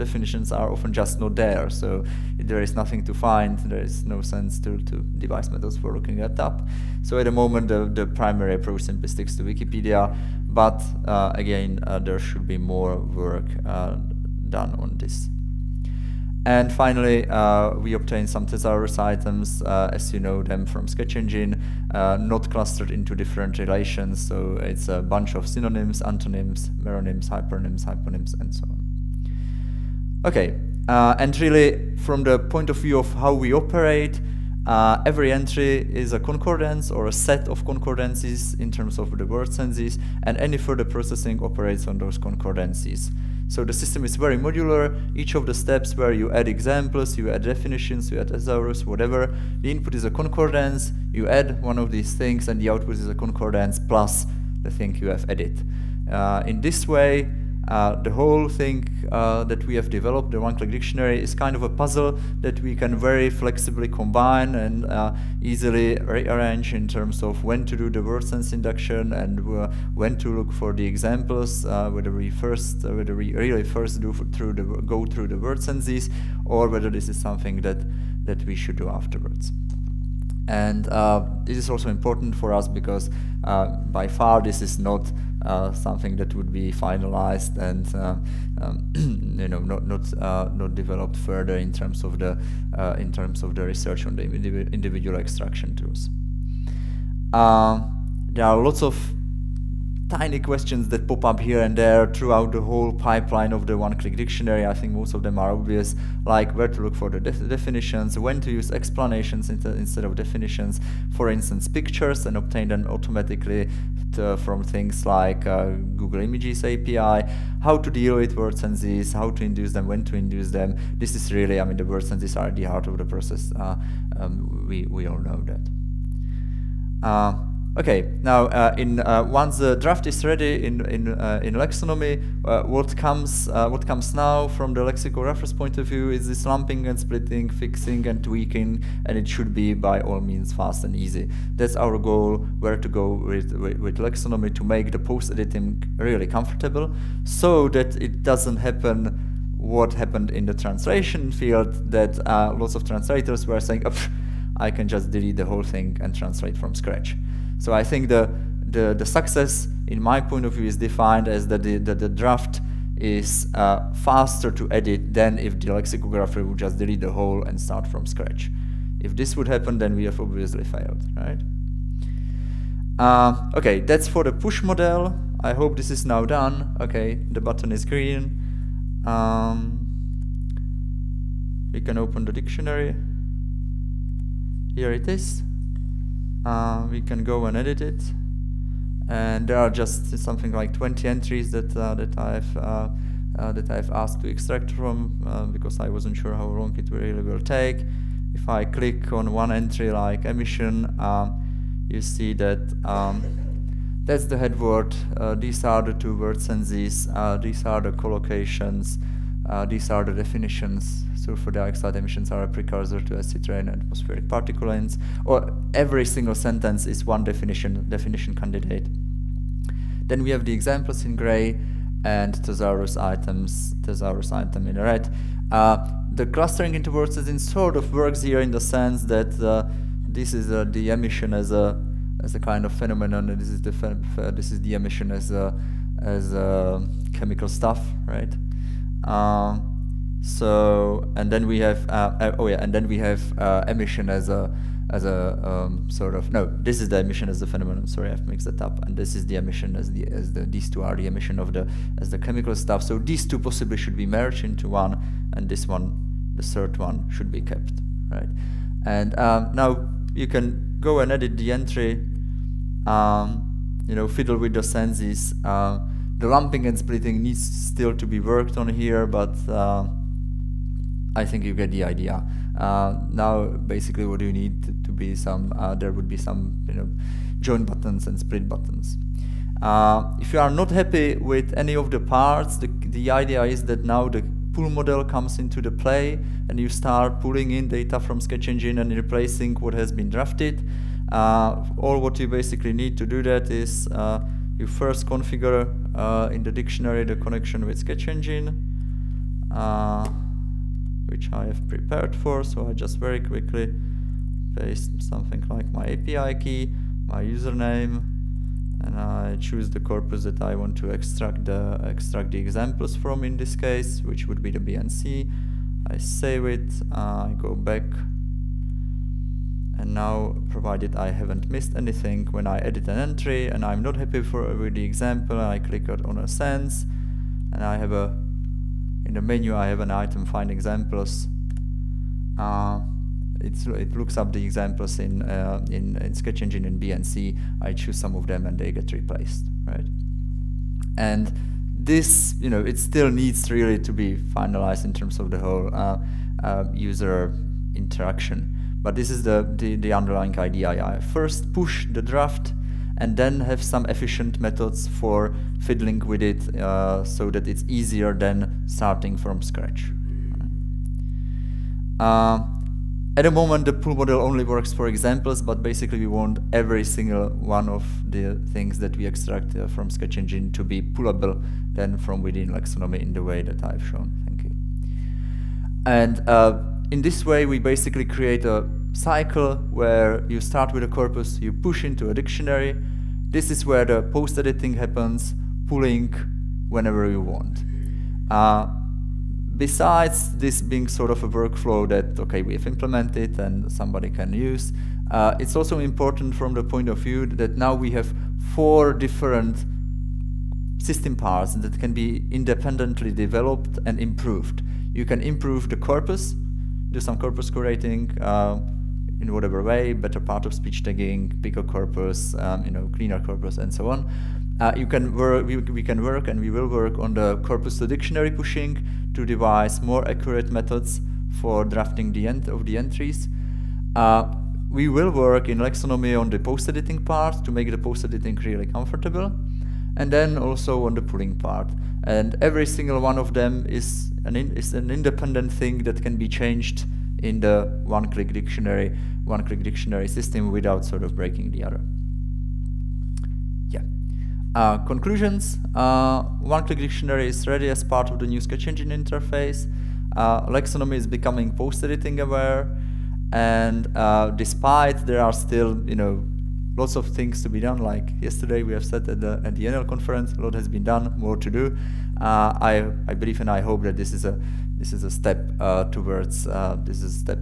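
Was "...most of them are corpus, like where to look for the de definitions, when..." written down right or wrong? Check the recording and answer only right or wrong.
wrong.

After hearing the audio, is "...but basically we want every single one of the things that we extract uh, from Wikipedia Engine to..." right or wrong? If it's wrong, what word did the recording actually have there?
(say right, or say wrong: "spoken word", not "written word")
wrong: "Sketch", not "Wikipedia".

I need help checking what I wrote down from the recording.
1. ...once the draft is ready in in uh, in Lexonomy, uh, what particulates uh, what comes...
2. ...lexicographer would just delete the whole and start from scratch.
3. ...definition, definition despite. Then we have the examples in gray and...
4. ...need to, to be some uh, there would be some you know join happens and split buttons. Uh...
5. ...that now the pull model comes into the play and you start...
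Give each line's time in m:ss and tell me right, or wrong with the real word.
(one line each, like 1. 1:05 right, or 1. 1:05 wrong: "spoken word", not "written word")
1. 2:09 wrong: "comes", not "particulates"
2. 2:45 right
3. 3:37 wrong: "candidate", not "despite"
4. 4:34 wrong: "buttons", not "happens"
5. 4:43 right.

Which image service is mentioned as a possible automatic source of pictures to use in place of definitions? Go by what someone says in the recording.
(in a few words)
Google Images API.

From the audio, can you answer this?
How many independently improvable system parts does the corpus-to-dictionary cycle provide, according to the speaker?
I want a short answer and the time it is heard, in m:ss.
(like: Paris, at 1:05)
4, at 6:38.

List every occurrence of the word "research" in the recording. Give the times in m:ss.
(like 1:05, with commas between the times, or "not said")
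1:33.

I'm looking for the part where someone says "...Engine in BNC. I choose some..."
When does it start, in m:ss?
5:36.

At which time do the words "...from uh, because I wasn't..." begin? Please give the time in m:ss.
3:14.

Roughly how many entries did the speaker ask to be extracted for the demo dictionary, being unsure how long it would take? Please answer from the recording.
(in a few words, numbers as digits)
20.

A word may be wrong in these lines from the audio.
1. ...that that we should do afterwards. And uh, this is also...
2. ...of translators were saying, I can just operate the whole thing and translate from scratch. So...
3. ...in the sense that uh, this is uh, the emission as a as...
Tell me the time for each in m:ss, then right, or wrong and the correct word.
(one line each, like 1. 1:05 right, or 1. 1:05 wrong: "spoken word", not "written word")
1. 1:17 right
2. 2:32 wrong: "delete", not "operate"
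3. 3:48 right.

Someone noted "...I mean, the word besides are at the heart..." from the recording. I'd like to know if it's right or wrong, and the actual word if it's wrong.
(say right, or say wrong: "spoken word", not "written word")
wrong: "senses", not "besides".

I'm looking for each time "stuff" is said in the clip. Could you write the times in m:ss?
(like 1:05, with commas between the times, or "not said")
3:57, 4:12.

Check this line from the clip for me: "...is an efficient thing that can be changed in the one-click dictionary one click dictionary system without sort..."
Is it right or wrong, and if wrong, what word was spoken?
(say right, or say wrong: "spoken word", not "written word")
wrong: "independent", not "efficient".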